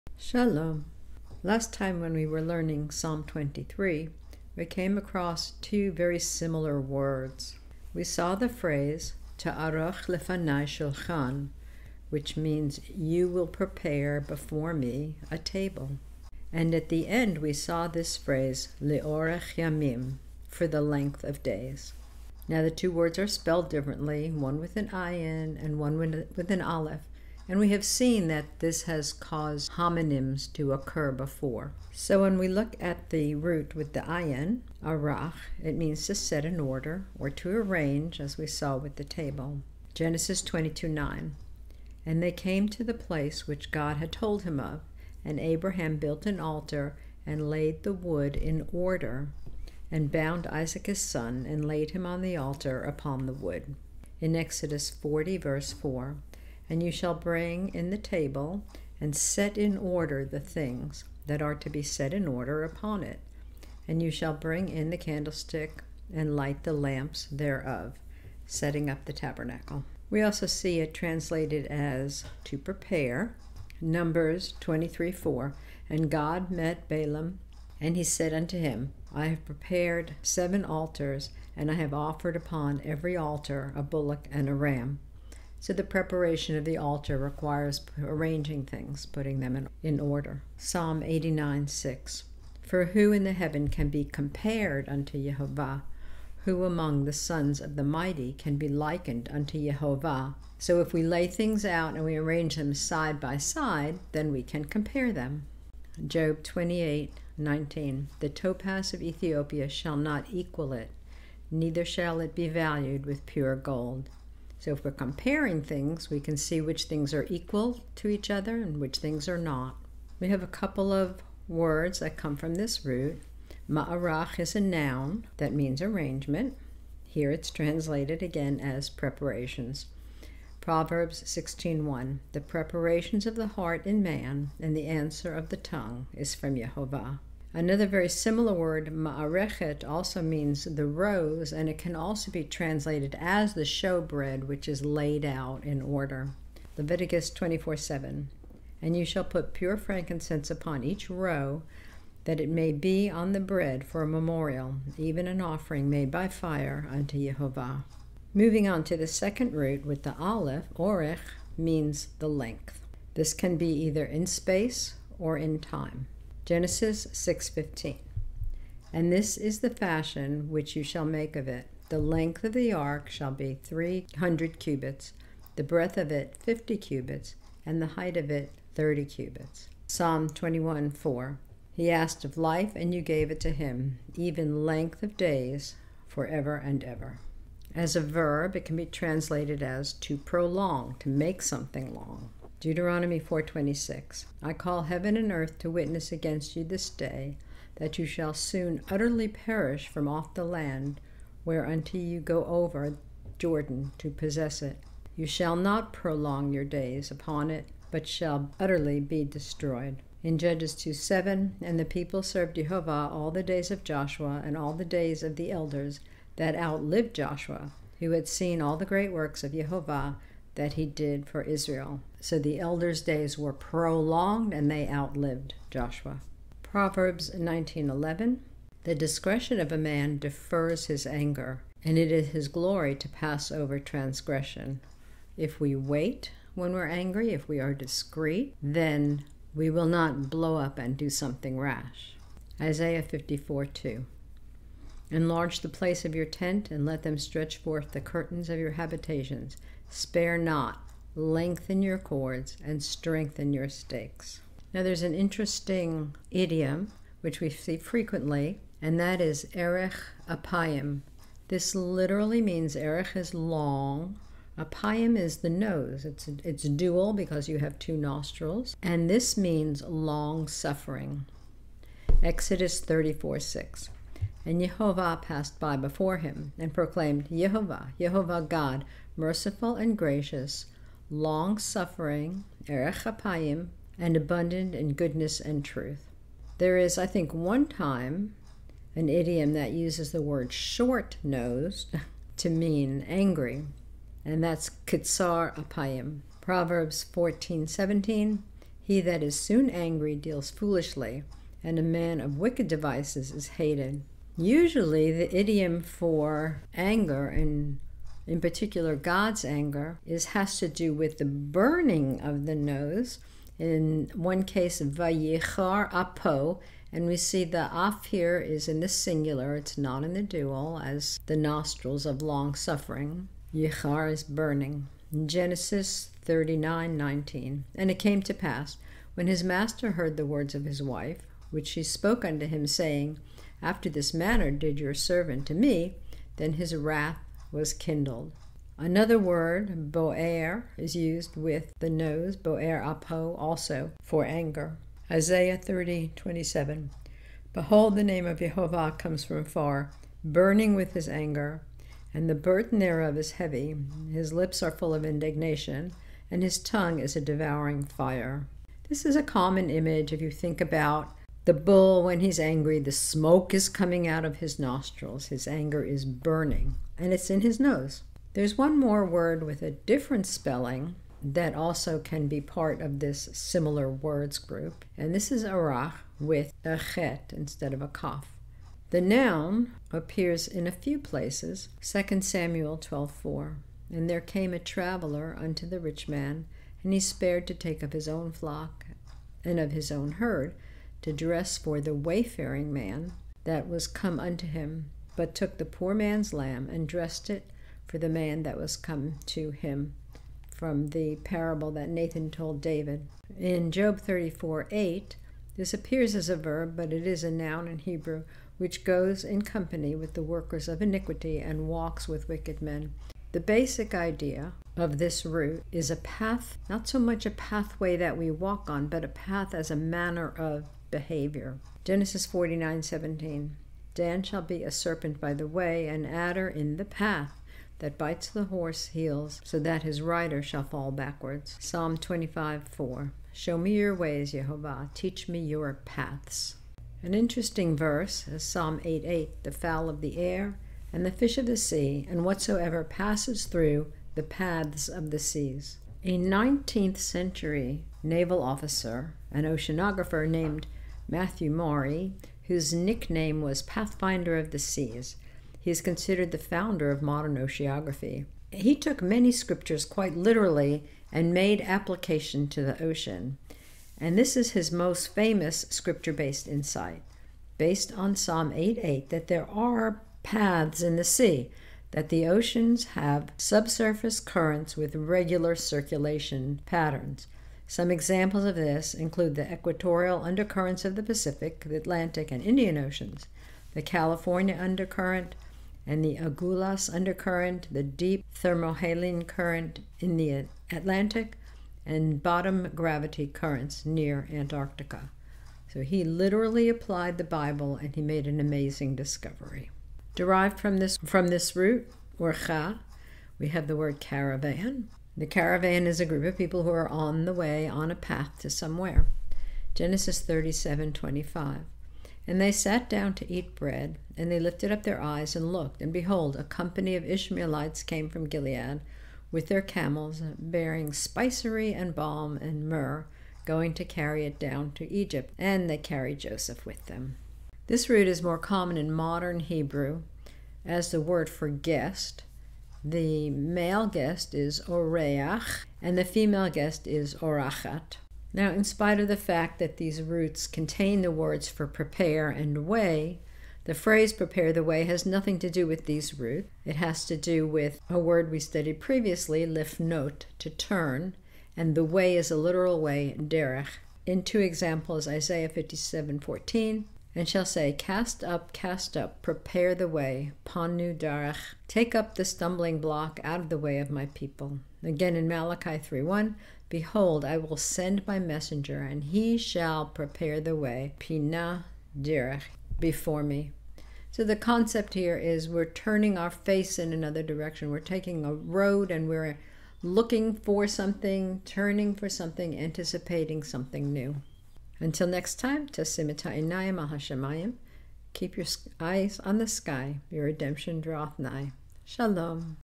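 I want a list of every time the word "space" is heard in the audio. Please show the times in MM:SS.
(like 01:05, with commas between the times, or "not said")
02:44.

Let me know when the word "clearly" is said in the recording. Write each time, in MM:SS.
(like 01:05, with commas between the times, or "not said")
not said.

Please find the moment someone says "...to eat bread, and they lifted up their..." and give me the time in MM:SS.
08:33.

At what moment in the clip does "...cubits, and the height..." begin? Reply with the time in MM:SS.
02:56.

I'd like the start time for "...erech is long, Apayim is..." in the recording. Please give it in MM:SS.
04:22.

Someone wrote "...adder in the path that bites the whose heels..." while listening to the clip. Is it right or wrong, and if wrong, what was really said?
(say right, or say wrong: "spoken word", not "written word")
wrong: "horse", not "whose".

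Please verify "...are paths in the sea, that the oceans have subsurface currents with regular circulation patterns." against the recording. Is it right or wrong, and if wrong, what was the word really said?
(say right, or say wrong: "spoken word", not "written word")
right.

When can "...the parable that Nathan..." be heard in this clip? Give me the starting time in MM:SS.
06:40.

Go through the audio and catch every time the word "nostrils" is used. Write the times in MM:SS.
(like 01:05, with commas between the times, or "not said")
04:27, 05:21, 06:04.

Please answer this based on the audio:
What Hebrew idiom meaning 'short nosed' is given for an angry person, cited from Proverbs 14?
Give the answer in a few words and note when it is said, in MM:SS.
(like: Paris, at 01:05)
kitsar apayim, at 04:54.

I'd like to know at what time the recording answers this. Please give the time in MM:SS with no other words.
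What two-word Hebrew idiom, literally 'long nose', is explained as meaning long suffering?
04:19.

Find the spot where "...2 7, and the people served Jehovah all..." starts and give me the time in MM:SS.
03:30.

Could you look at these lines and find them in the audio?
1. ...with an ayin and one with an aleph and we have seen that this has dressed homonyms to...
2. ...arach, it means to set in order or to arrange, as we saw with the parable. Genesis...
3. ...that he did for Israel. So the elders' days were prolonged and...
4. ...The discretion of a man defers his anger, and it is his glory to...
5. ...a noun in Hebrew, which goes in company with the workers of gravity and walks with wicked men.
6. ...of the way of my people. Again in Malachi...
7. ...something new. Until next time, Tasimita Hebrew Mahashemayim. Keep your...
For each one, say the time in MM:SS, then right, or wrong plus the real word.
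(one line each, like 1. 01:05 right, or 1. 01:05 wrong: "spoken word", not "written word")
1. 00:24 wrong: "caused", not "dressed"
2. 00:34 wrong: "table", not "parable"
3. 03:40 right
4. 03:48 right
5. 06:47 wrong: "iniquity", not "gravity"
6. 09:23 right
7. 09:43 wrong: "Inaya", not "Hebrew".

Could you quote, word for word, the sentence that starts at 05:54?
His lips are full of indignation, and his tongue is a devouring fire.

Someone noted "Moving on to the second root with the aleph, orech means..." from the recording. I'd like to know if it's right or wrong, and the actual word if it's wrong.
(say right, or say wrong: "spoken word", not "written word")
right.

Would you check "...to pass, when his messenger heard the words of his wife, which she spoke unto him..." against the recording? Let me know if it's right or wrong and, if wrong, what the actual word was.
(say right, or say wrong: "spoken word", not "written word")
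wrong: "master", not "messenger".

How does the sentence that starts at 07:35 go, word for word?
He is considered the founder of modern oceanography.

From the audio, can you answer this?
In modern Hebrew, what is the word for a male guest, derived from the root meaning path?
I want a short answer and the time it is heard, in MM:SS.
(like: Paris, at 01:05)
oreach, at 08:54.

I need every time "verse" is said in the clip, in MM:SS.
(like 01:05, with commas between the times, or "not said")
00:55, 07:17.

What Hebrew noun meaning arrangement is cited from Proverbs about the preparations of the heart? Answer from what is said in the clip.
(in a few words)
Ma'arach.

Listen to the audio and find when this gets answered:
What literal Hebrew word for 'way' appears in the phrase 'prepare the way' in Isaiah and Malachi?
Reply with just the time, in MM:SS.
09:13.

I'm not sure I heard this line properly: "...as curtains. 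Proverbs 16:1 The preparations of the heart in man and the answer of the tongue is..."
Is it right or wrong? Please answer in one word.
wrong.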